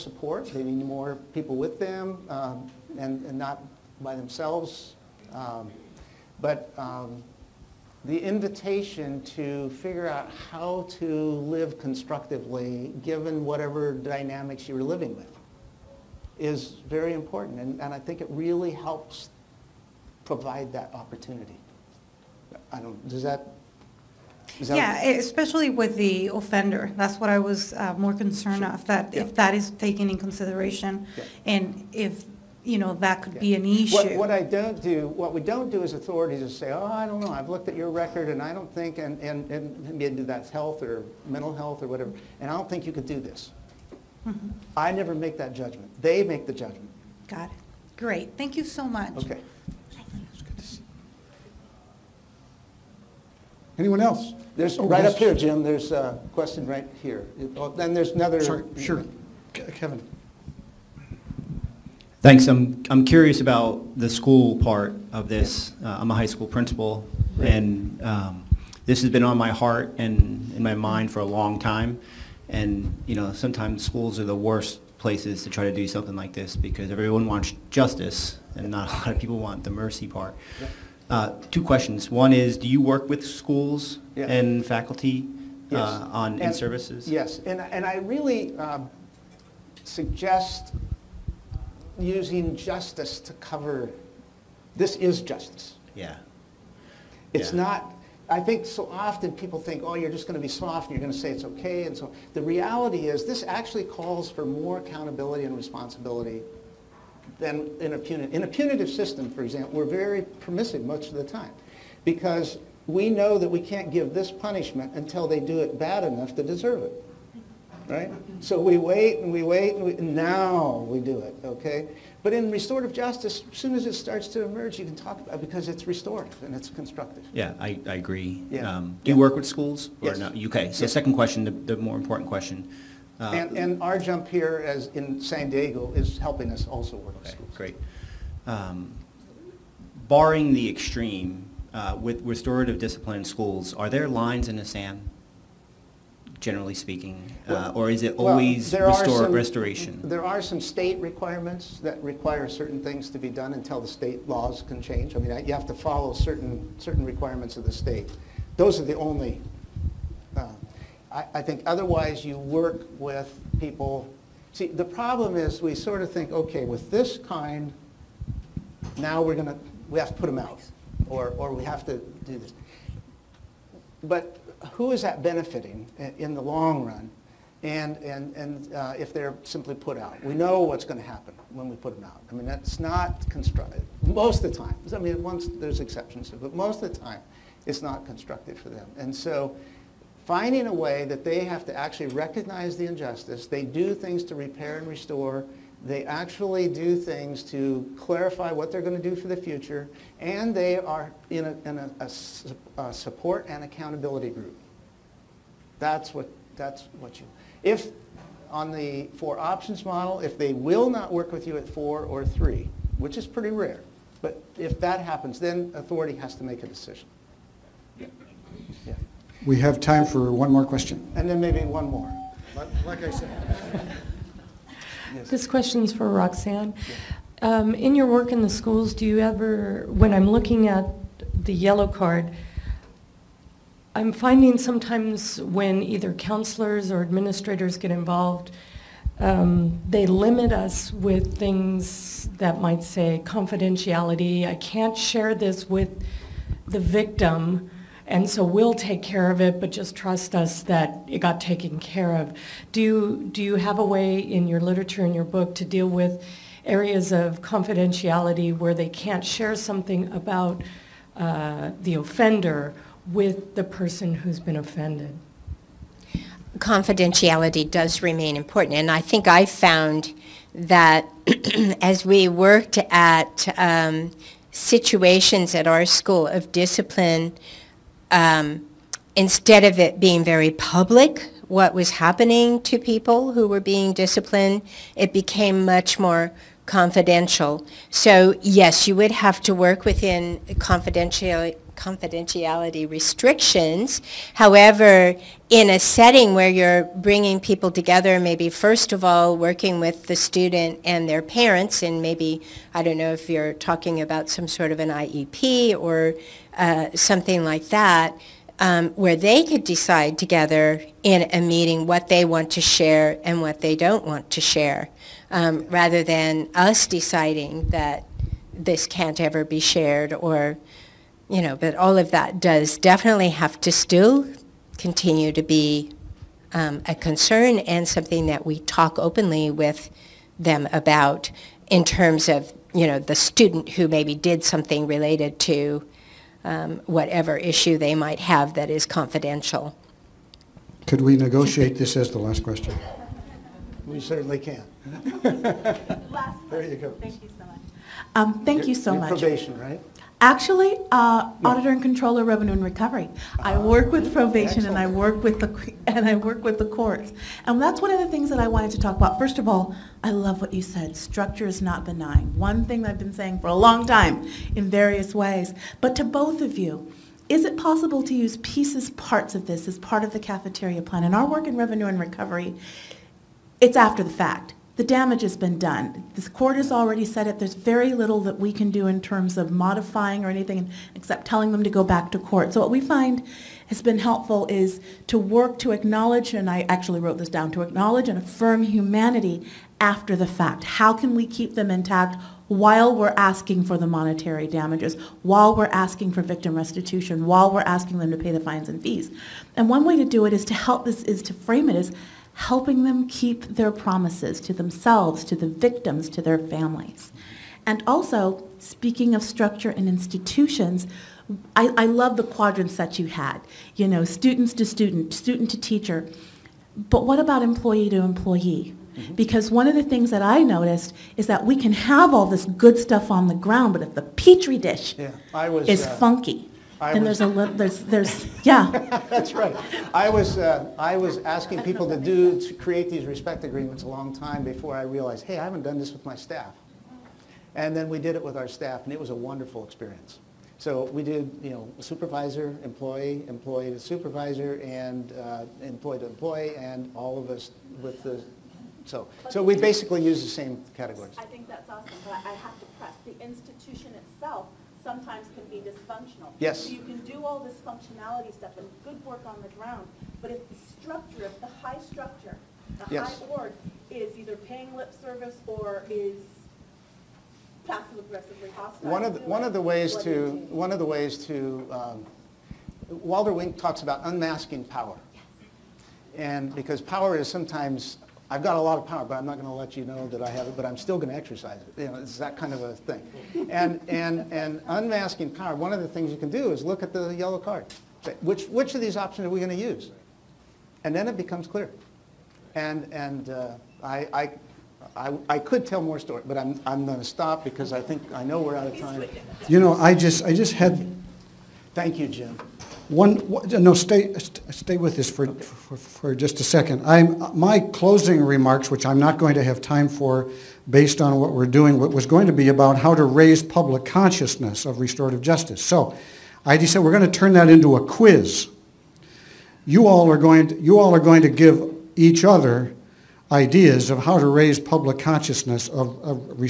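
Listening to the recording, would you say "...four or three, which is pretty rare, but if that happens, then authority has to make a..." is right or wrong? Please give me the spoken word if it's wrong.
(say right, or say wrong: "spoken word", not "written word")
right.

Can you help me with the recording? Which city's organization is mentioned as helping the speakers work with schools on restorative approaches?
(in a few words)
San Diego.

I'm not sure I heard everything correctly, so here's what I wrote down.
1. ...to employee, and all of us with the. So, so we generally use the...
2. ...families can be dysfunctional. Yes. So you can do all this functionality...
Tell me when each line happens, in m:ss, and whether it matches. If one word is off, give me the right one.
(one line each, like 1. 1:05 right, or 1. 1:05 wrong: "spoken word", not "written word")
1. 7:25 wrong: "basically", not "generally"
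2. 7:34 wrong: "sometimes", not "families".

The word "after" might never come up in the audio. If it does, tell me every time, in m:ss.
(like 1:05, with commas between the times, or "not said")
6:13, 6:29.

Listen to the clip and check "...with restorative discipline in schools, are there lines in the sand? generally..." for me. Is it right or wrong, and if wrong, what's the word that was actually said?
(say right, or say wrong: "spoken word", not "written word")
right.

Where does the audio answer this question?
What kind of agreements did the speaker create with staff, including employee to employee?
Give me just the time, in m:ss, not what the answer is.
7:13.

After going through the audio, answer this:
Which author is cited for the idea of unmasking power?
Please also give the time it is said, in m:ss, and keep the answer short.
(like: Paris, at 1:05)
Walter Wink, at 7:52.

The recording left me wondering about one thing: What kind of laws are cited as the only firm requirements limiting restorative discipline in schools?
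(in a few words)
state laws.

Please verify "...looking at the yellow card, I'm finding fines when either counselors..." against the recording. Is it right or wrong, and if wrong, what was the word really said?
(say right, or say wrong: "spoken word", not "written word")
wrong: "sometimes", not "fines".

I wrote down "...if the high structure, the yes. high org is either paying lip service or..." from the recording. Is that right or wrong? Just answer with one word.
right.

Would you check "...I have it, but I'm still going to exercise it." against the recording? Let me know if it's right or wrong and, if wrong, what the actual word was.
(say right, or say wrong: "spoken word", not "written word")
right.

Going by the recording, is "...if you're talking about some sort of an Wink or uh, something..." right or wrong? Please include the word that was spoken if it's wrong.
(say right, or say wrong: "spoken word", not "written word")
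wrong: "IEP", not "Wink".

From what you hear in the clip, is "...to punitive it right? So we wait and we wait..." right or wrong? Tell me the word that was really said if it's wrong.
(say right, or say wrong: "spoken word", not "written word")
wrong: "deserve", not "punitive".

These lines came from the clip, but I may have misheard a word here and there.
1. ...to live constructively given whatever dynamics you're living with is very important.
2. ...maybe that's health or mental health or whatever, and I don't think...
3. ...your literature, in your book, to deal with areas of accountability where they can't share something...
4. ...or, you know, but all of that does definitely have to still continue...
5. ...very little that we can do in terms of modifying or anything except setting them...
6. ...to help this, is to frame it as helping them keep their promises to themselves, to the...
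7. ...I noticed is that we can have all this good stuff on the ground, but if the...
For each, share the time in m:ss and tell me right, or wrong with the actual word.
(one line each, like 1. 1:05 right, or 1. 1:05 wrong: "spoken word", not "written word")
1. 0:10 right
2. 0:39 right
3. 4:14 wrong: "confidentiality", not "accountability"
4. 5:20 right
5. 6:17 wrong: "telling", not "setting"
6. 6:40 right
7. 7:00 right.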